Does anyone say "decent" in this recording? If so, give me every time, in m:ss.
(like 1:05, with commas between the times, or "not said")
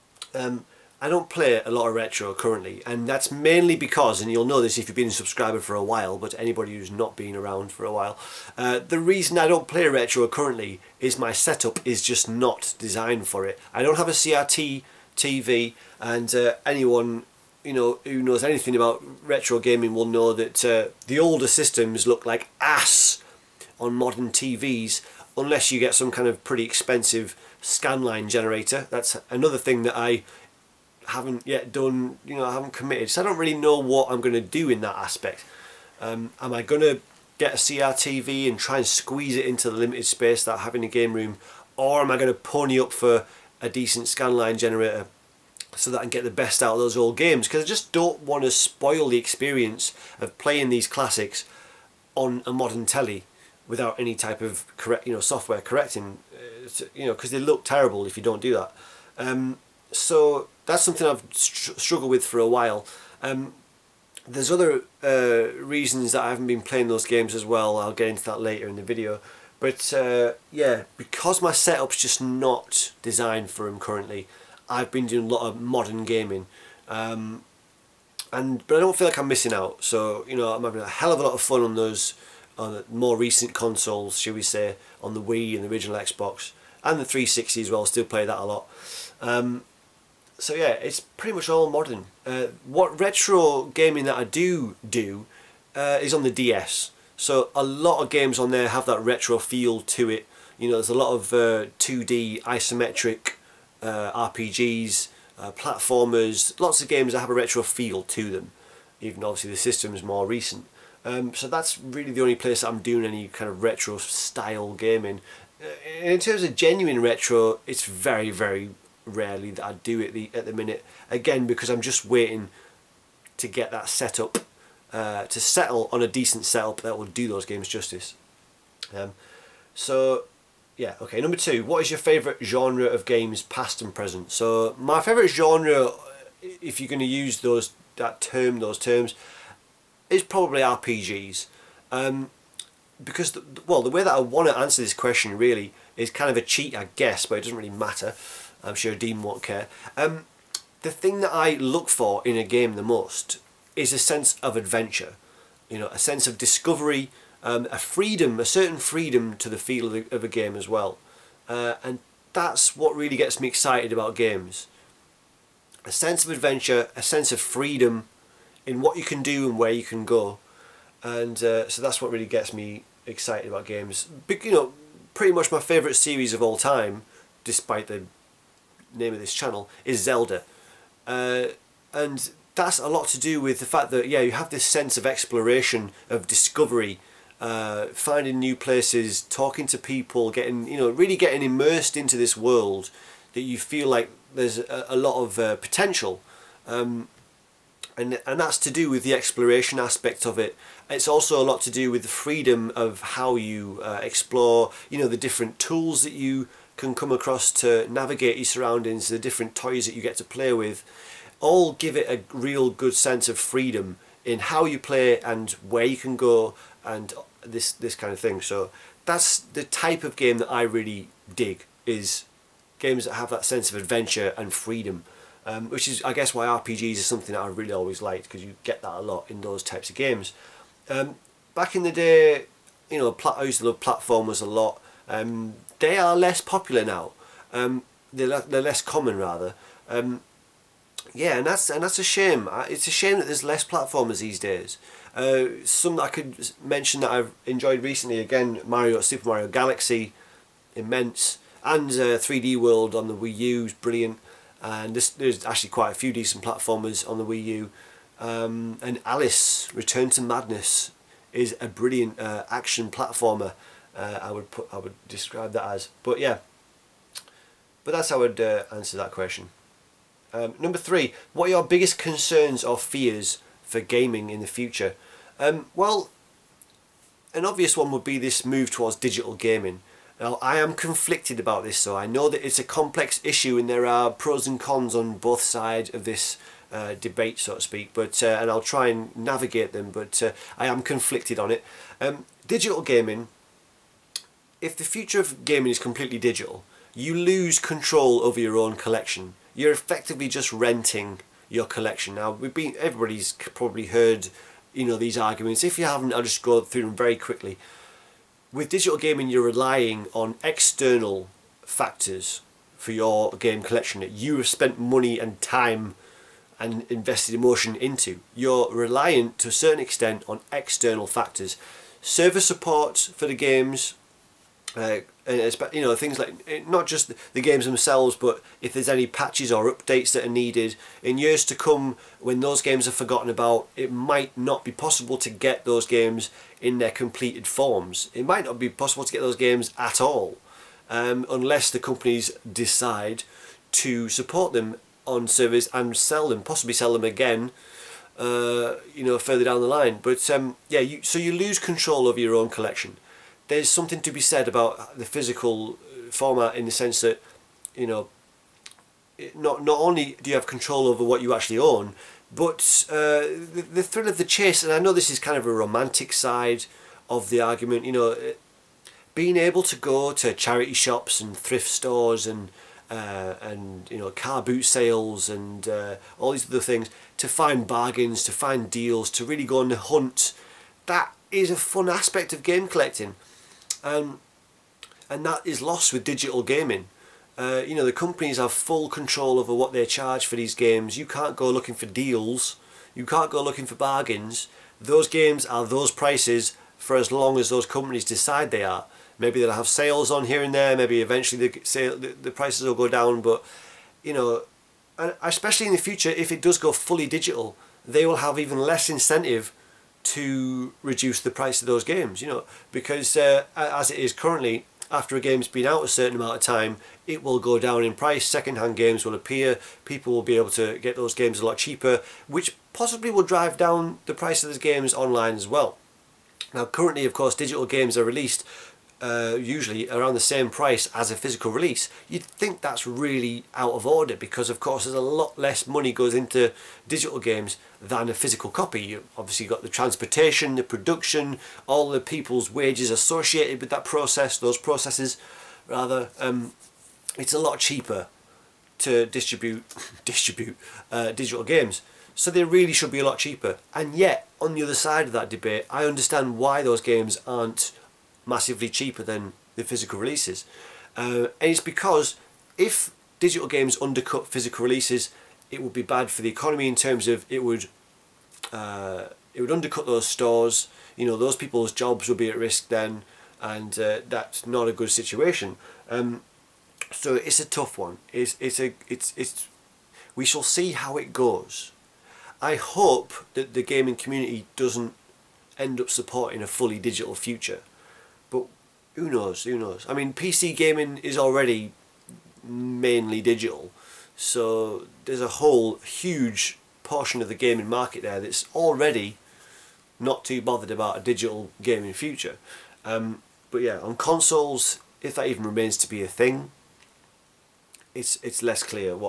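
0:43, 2:06, 4:16.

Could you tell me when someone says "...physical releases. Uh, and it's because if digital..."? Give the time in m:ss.
7:39.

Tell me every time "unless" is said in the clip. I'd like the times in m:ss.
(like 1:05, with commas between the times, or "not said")
0:25, 5:41.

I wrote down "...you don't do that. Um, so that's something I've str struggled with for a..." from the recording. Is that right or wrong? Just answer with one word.
right.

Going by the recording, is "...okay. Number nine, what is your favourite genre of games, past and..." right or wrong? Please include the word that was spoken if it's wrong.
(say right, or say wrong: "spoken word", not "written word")
wrong: "two", not "nine".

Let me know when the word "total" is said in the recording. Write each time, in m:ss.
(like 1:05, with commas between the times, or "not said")
not said.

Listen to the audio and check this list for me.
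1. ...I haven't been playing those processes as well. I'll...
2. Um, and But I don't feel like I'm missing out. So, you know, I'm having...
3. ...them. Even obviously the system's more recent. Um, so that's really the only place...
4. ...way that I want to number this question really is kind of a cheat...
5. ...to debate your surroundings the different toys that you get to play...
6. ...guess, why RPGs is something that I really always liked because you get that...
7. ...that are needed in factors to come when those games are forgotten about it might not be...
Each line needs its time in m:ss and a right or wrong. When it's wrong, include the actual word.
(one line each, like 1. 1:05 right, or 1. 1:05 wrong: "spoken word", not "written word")
1. 1:06 wrong: "games", not "processes"
2. 1:16 right
3. 1:48 right
4. 2:23 wrong: "answer", not "number"
5. 3:27 wrong: "navigate", not "debate"
6. 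3:46 right
7. 5:30 wrong: "years", not "factors".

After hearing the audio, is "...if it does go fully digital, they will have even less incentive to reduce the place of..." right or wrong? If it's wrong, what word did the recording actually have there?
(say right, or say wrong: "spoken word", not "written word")
wrong: "price", not "place".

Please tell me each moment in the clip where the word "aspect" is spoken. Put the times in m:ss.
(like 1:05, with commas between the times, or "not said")
0:34, 3:19, 6:21.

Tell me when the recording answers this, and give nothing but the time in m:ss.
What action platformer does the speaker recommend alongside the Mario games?
4:19.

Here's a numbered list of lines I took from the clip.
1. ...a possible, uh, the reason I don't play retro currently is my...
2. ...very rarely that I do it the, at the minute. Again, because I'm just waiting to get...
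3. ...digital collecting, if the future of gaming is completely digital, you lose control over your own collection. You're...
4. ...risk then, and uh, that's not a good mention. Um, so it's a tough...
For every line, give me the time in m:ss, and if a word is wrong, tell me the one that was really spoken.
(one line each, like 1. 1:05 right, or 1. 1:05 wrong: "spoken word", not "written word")
1. 0:07 wrong: "while", not "possible"
2. 1:58 right
3. 4:52 wrong: "gaming", not "collecting"
4. 7:52 wrong: "situation", not "mention".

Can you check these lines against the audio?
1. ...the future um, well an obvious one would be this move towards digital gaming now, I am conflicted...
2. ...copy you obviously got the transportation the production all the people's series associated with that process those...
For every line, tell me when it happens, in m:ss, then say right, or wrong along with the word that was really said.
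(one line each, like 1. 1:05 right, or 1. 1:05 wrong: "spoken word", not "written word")
1. 4:34 right
2. 7:18 wrong: "wages", not "series".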